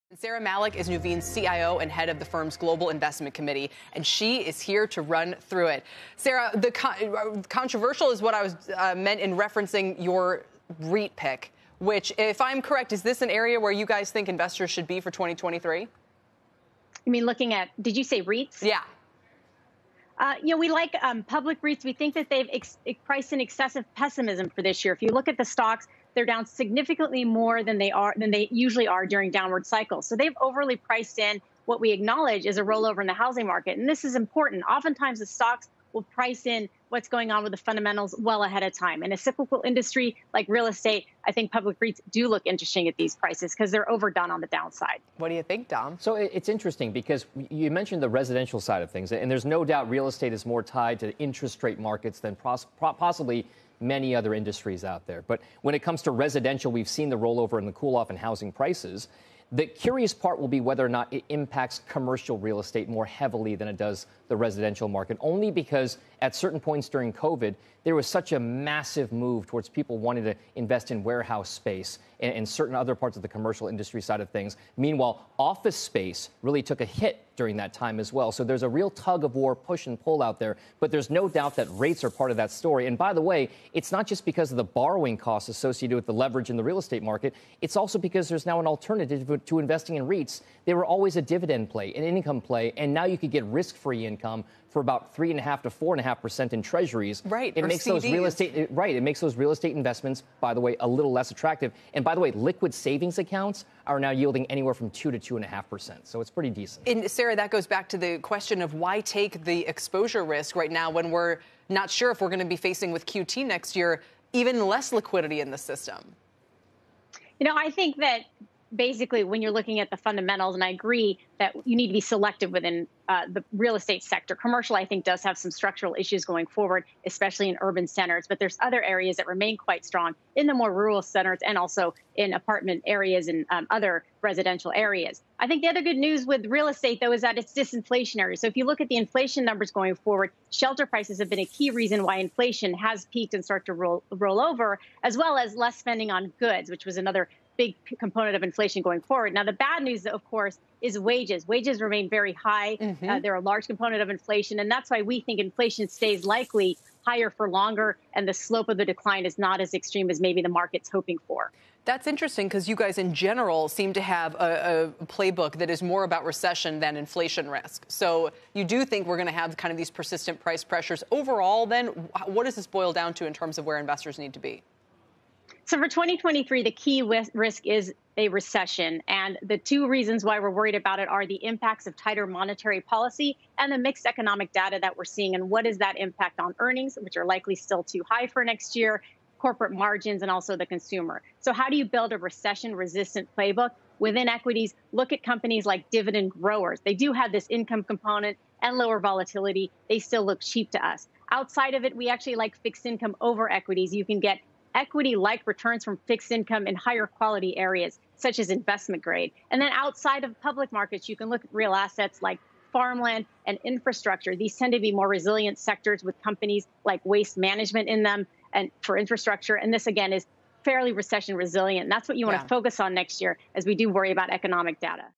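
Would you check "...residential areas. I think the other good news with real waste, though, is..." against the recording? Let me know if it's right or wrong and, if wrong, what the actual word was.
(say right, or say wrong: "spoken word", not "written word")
wrong: "estate", not "waste".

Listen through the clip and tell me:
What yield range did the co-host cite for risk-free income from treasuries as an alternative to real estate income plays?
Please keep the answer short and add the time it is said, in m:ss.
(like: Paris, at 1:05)
3.5% to 4.5%, at 1:35.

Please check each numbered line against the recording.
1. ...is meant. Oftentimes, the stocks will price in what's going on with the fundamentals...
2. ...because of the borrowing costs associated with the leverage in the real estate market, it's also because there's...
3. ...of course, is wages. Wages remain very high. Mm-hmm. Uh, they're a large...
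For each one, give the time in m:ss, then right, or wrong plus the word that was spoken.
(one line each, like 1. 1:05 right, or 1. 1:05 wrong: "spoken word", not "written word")
1. 0:34 wrong: "important", not "meant"
2. 1:24 right
3. 2:30 right.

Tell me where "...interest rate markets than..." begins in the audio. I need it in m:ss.
0:51.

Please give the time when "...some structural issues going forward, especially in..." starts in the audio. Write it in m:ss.
2:05.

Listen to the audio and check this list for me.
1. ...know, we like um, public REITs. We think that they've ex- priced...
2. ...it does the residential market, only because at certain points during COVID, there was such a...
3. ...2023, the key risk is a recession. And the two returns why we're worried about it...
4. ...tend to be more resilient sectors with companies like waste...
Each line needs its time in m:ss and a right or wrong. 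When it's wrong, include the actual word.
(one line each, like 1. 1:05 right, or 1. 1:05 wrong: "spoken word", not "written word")
1. 0:20 right
2. 1:03 right
3. 2:55 wrong: "reasons", not "returns"
4. 3:34 right.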